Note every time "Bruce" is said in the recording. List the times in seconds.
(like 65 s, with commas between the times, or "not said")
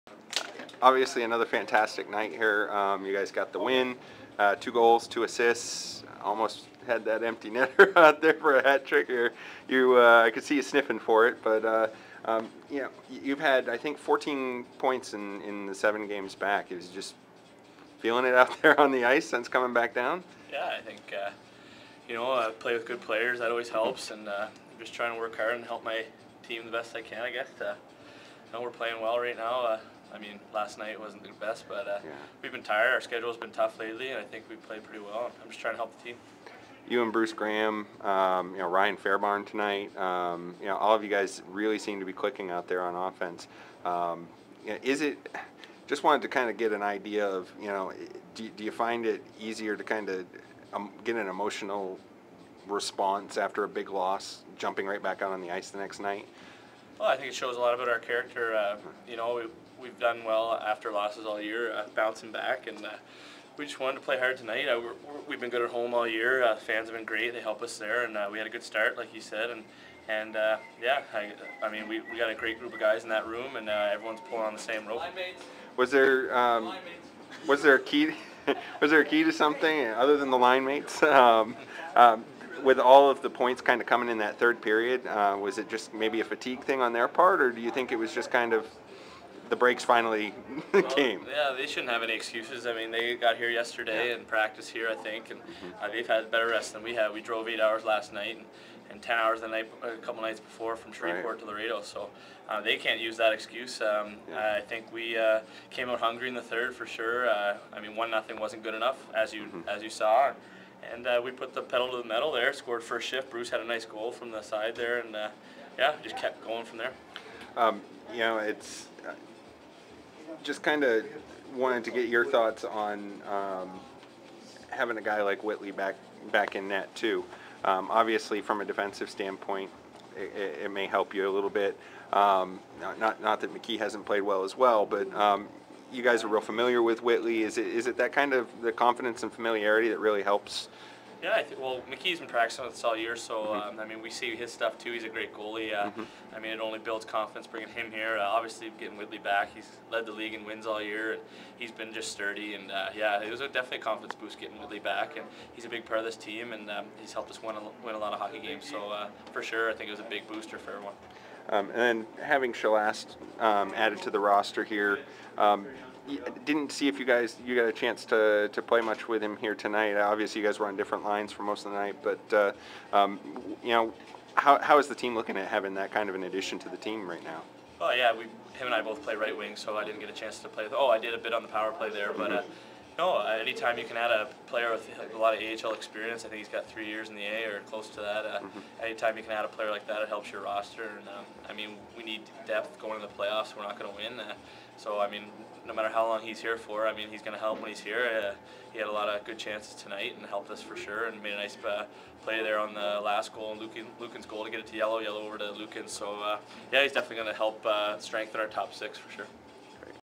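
37 s, 113 s.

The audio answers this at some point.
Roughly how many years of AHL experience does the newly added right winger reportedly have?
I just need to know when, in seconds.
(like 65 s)
186 s.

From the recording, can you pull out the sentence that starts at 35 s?
I'm just trying to help the team.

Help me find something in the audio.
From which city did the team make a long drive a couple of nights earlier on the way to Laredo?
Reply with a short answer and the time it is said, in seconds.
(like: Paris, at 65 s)
Shreveport, at 100 s.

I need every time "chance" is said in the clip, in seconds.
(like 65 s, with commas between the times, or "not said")
167 s, 180 s, 199 s.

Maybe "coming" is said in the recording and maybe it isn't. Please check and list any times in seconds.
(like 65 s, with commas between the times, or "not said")
19 s, 83 s.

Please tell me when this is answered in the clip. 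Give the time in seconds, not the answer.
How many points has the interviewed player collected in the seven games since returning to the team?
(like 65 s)
13 s.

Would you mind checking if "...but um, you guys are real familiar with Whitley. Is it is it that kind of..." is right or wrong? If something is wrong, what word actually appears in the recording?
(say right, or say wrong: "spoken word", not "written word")
right.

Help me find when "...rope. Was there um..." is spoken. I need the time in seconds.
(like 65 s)
74 s.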